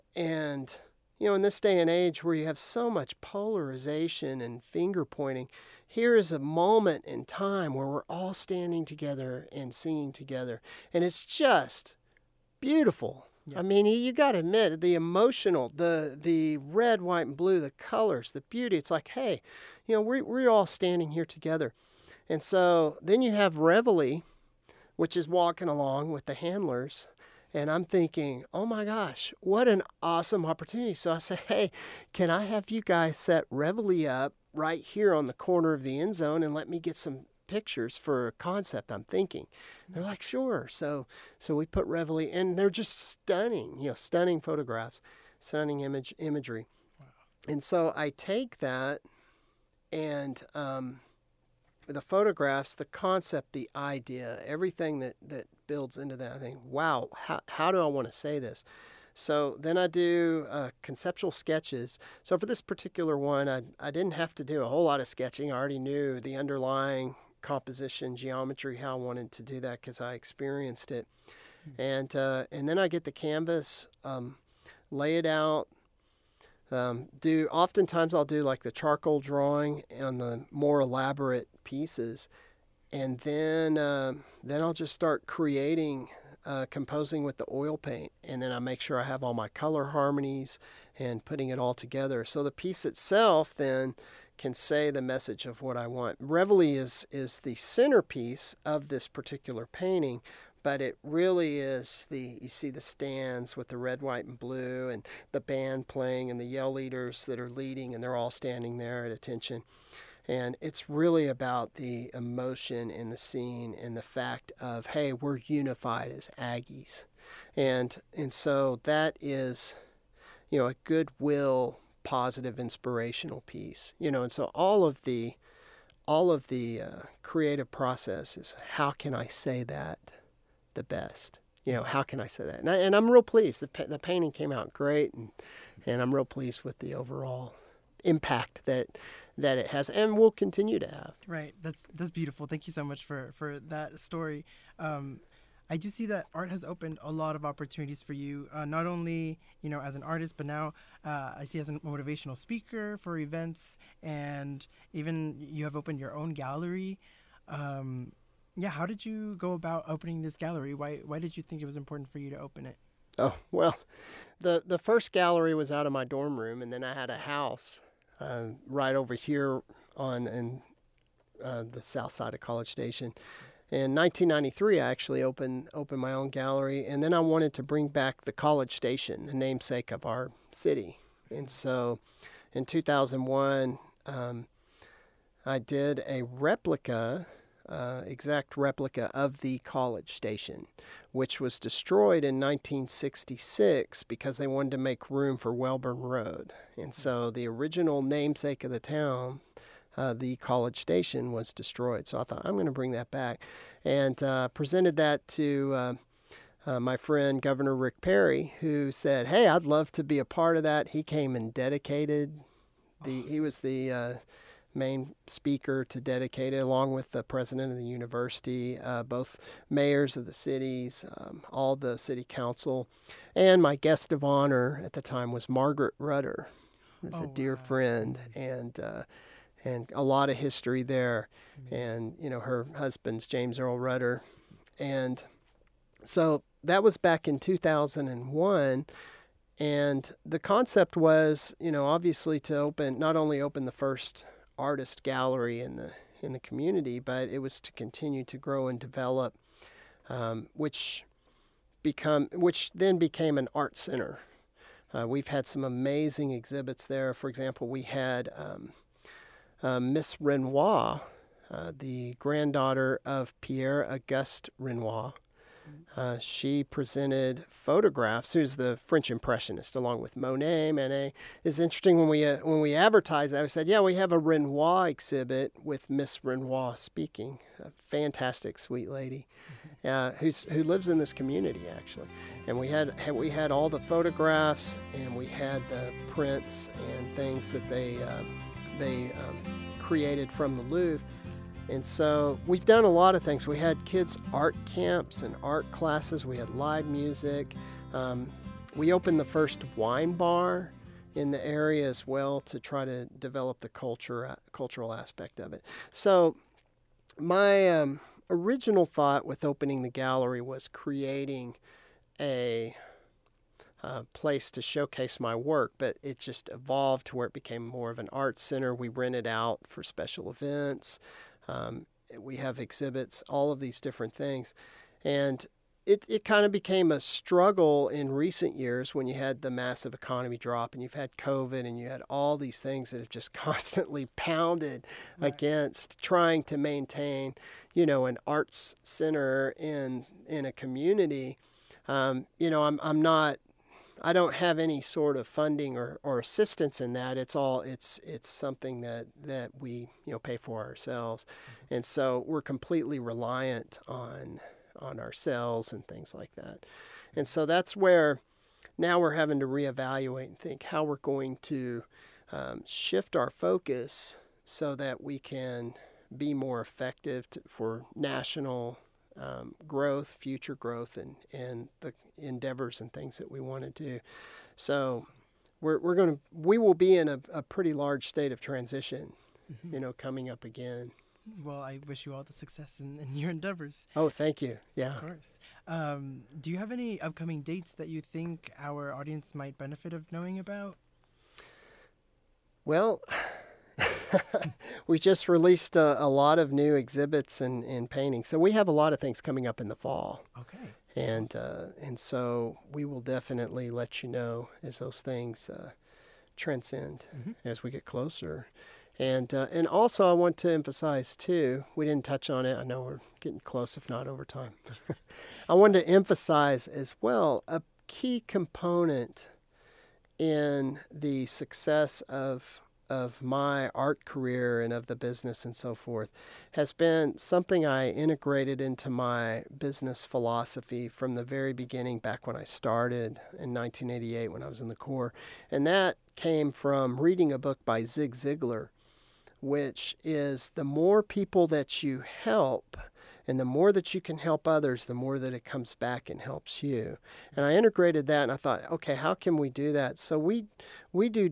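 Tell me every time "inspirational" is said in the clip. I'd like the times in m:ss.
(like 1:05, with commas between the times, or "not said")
2:02.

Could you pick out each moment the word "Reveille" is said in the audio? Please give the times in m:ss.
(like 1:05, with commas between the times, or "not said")
0:23, 0:33, 0:41, 1:36.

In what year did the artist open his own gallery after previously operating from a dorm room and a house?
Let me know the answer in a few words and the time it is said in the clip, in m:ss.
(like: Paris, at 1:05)
1993, at 2:53.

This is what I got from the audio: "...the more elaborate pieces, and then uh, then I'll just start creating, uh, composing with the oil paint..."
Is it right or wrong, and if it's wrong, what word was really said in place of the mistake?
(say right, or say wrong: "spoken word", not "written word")
right.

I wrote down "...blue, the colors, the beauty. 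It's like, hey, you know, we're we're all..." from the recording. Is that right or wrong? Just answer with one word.
right.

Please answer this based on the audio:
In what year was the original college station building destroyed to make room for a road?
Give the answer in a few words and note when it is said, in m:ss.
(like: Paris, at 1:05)
1966, at 3:11.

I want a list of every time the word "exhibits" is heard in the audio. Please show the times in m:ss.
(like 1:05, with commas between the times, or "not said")
4:16, 4:34, 5:22, 6:36.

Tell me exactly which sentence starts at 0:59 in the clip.
So then I do uh, conceptual sketches.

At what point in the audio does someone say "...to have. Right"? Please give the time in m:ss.
2:20.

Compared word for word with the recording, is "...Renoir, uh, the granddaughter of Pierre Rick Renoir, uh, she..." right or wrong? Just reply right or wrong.
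wrong.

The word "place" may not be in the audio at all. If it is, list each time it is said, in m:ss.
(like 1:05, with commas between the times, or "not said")
5:14.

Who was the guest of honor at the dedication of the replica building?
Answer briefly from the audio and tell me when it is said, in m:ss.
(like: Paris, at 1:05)
Margaret Rudder, at 3:45.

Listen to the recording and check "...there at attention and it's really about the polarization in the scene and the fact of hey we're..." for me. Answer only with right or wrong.
wrong.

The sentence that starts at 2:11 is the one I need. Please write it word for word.
You know, how can I say that?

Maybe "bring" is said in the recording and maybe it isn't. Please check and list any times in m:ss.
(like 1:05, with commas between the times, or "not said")
2:57, 3:22.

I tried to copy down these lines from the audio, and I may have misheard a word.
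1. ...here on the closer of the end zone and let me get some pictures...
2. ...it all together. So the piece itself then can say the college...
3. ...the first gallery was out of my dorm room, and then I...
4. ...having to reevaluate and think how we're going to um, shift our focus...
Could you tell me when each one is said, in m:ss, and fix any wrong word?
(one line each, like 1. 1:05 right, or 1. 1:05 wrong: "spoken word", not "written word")
1. 0:34 wrong: "corner", not "closer"
2. 1:31 wrong: "message", not "college"
3. 2:44 right
4. 5:59 right.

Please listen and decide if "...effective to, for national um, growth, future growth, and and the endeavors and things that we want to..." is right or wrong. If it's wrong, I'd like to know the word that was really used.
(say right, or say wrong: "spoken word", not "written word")
right.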